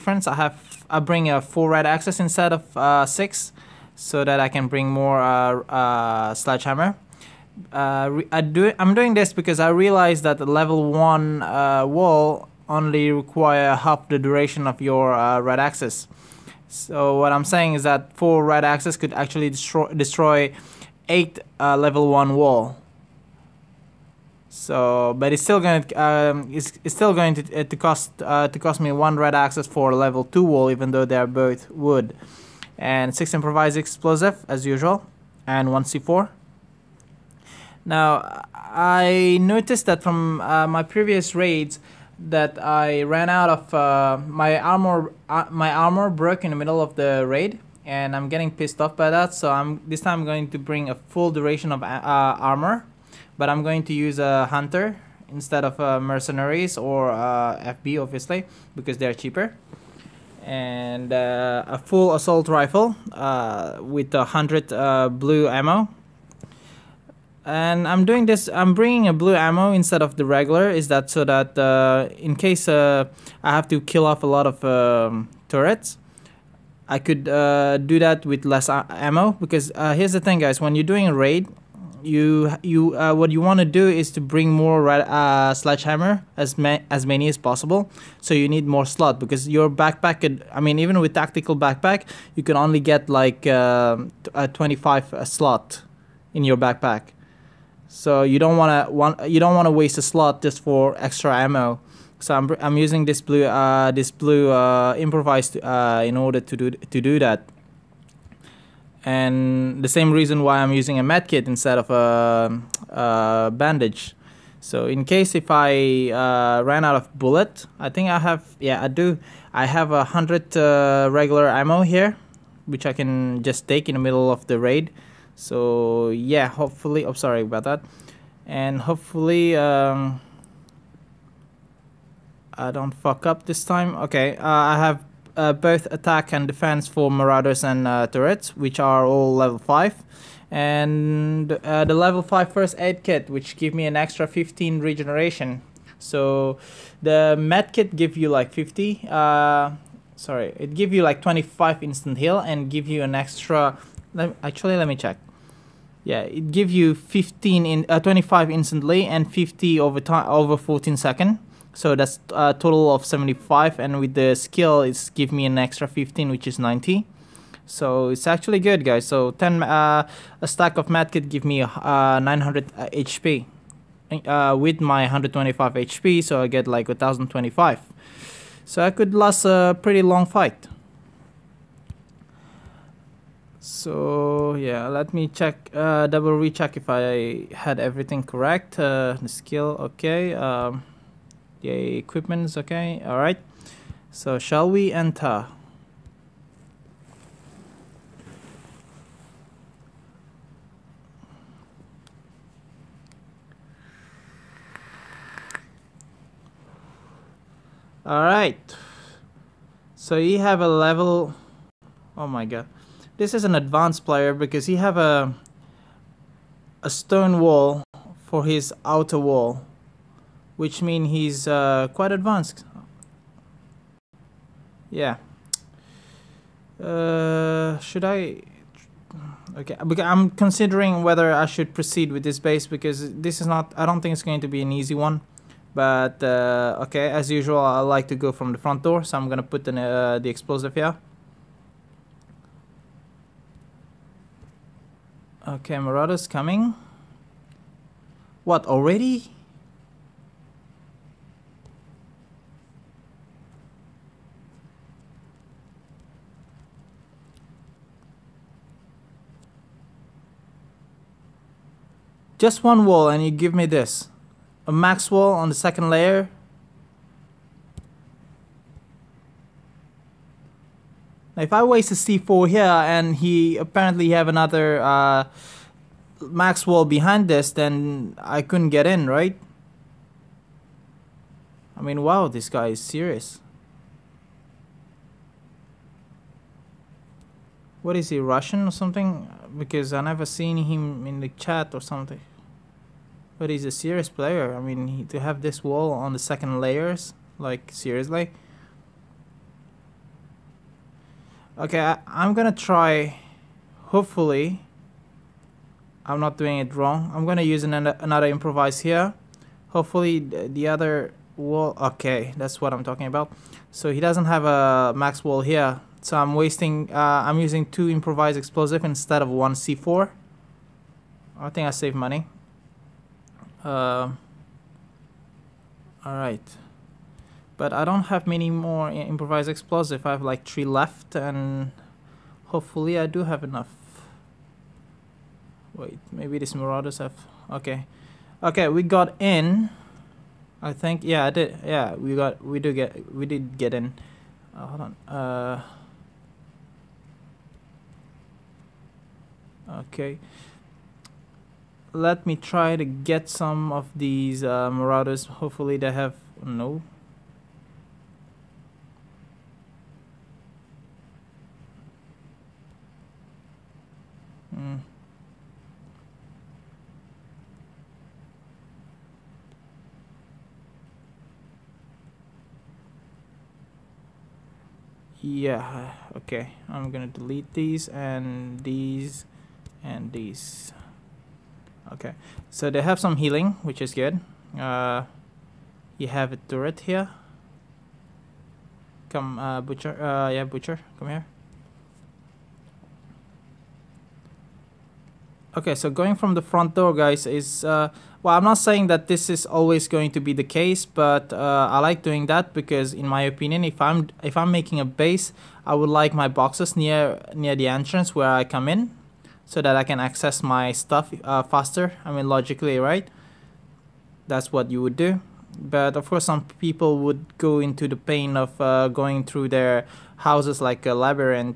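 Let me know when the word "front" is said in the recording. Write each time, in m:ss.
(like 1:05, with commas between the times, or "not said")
3:58, 6:36.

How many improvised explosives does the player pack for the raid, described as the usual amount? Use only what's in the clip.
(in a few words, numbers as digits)
6.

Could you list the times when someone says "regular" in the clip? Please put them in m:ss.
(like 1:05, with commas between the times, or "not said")
1:10, 2:01.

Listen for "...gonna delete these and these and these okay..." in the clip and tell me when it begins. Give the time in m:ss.
6:16.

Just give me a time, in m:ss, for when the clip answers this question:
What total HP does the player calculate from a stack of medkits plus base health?
2:56.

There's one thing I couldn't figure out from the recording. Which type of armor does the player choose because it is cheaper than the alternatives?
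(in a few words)
Hunter.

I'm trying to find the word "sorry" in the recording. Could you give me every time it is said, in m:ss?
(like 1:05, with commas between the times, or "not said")
2:07, 2:30.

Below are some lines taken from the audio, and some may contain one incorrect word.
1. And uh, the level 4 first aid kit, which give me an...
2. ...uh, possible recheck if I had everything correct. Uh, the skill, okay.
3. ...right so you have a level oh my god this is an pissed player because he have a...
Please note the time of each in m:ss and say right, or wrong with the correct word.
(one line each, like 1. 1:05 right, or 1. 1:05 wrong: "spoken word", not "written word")
1. 2:20 wrong: "5", not "4"
2. 3:05 wrong: "double", not "possible"
3. 3:28 wrong: "advanced", not "pissed".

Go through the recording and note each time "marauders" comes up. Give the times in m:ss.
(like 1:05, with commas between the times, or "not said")
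2:17, 4:05, 5:36, 5:54.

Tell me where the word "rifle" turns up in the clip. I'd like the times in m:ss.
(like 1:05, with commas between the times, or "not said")
1:02.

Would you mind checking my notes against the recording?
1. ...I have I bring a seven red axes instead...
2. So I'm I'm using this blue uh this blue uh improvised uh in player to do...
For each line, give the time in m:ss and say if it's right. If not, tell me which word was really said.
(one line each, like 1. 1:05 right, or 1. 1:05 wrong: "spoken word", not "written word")
1. 0:00 wrong: "four", not "seven"
2. 1:42 wrong: "order", not "player".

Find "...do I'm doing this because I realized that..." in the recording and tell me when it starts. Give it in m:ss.
0:08.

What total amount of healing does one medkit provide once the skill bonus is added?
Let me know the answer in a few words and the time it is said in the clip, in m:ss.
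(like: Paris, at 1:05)
90, at 2:46.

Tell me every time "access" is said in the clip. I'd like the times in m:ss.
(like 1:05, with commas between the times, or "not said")
0:29, 6:49.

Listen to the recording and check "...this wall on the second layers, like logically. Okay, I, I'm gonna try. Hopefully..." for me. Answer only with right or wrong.
wrong.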